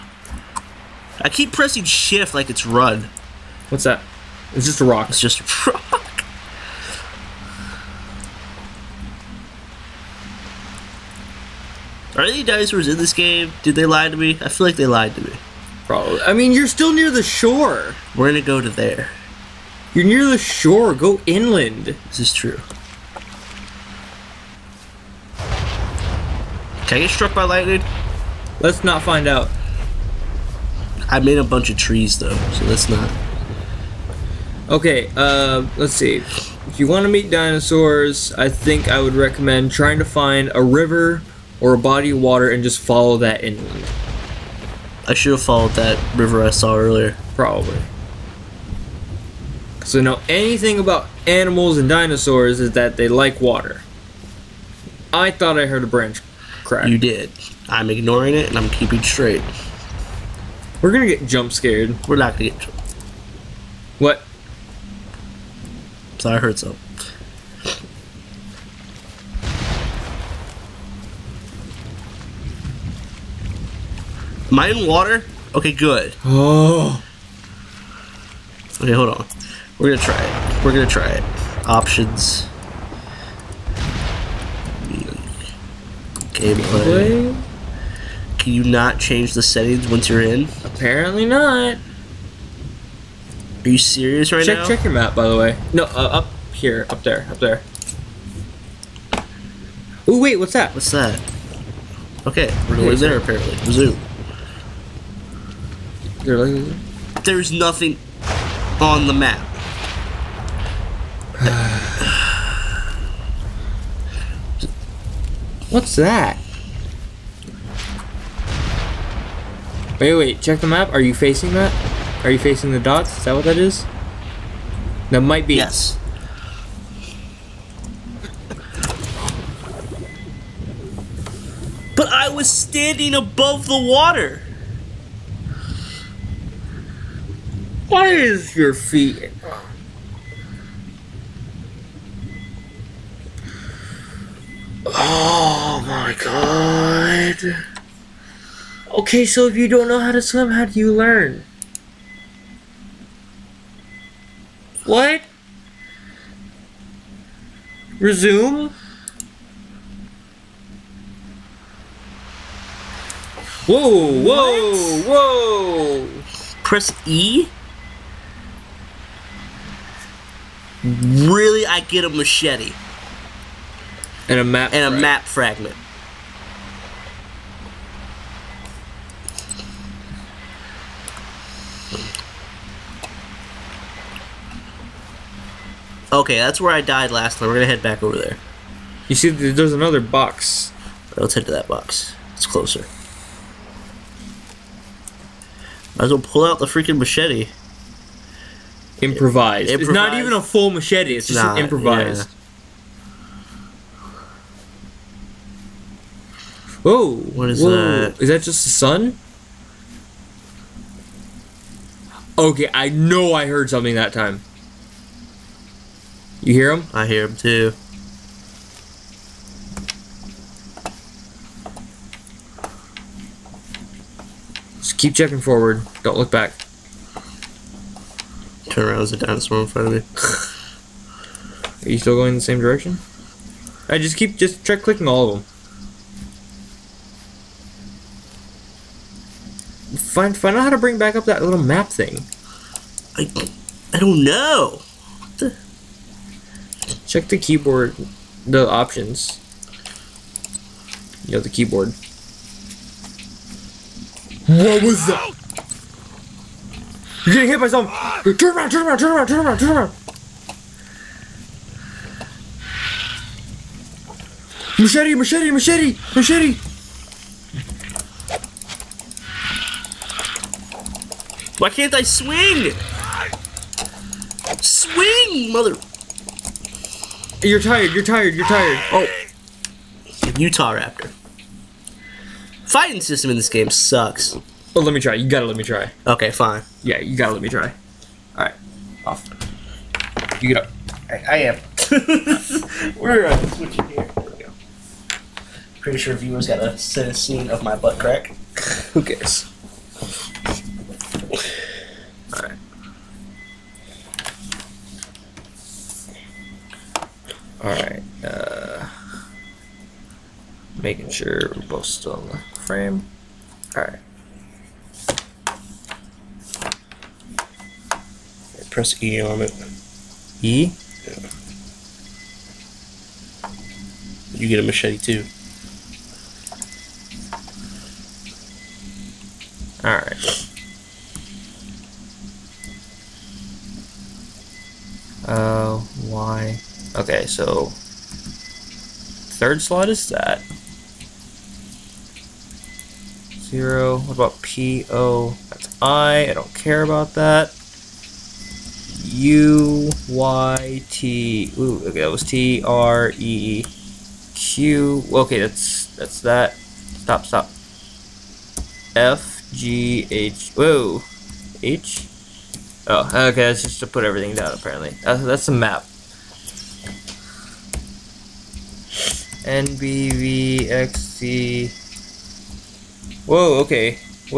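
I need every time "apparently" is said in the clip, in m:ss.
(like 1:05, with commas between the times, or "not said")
1:30, 1:43, 6:04.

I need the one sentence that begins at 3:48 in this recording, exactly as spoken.
Turn around, there's a dinosaur in front of me.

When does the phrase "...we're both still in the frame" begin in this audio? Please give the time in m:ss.
5:11.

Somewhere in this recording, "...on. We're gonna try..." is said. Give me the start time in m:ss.
1:19.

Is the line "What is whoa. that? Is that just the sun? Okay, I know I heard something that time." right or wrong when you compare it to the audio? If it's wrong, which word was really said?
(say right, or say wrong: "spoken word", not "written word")
right.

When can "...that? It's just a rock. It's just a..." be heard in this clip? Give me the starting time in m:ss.
0:03.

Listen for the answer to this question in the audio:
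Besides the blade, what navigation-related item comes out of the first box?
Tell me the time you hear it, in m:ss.
2:54.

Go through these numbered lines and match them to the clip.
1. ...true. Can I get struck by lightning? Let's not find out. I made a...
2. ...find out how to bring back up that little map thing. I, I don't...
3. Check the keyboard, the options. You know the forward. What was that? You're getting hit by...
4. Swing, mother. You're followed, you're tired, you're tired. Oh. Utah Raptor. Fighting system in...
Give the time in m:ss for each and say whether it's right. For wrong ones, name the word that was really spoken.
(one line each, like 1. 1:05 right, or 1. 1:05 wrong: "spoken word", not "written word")
1. 0:22 right
2. 4:00 right
3. 4:07 wrong: "keyboard", not "forward"
4. 4:34 wrong: "tired", not "followed".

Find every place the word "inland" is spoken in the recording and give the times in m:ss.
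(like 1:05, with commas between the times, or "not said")
0:21, 0:43.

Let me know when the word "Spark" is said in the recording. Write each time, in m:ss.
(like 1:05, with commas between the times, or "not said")
not said.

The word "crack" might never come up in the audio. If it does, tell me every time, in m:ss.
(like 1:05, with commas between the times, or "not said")
0:56, 4:57.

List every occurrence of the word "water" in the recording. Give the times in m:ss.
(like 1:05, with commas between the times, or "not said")
0:42, 0:53, 1:14, 2:13.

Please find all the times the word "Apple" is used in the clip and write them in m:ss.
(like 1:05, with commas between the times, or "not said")
not said.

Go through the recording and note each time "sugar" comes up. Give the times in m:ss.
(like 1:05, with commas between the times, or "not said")
not said.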